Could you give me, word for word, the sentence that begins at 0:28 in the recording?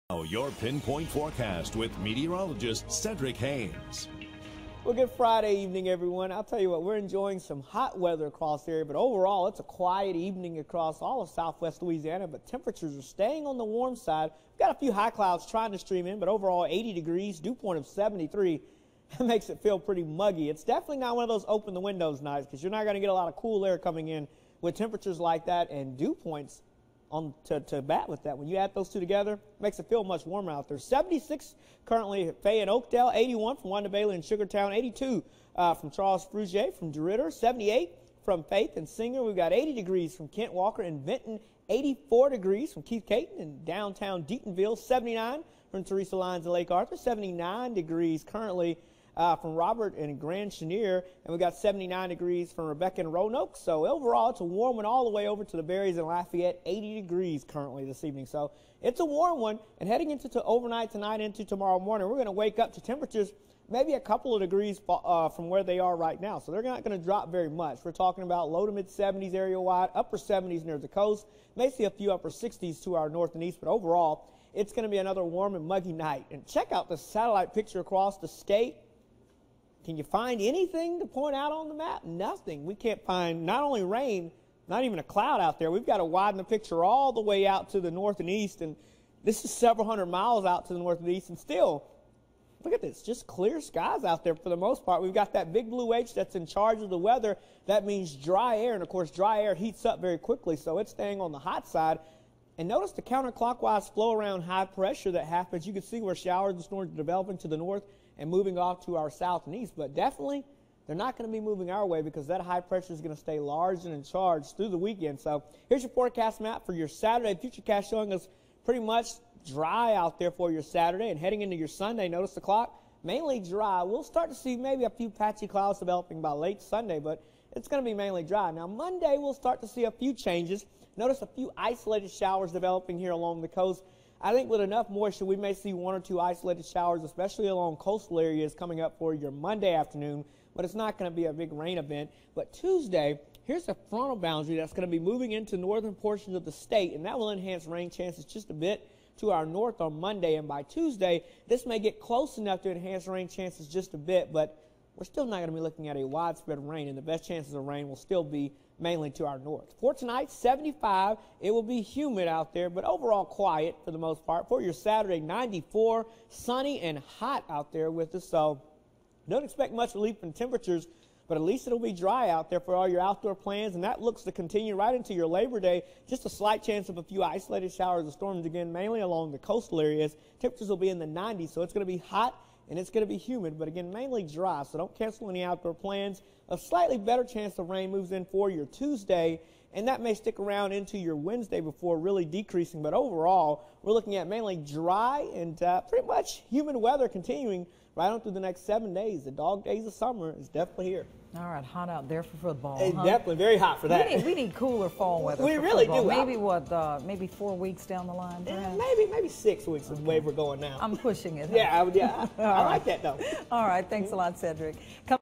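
When you add those two together, makes it feel much warmer out there.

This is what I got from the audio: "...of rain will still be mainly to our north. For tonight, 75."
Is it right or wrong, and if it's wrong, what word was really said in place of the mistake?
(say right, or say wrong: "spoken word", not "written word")
right.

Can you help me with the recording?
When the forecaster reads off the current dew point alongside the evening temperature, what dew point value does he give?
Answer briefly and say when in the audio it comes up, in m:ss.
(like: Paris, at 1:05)
73, at 0:17.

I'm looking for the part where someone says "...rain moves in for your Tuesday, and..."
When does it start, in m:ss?
3:07.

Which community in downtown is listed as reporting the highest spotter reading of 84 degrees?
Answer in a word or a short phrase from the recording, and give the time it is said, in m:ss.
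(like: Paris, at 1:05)
Deatonville, at 0:43.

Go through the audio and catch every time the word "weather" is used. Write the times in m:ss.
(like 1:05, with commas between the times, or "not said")
0:07, 1:36, 3:16, 3:25.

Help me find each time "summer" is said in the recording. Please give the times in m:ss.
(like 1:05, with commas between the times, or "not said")
3:19.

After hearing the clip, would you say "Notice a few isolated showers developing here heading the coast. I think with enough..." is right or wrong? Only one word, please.
wrong.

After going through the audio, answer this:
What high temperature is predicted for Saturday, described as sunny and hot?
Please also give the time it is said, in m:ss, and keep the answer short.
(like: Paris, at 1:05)
94, at 2:45.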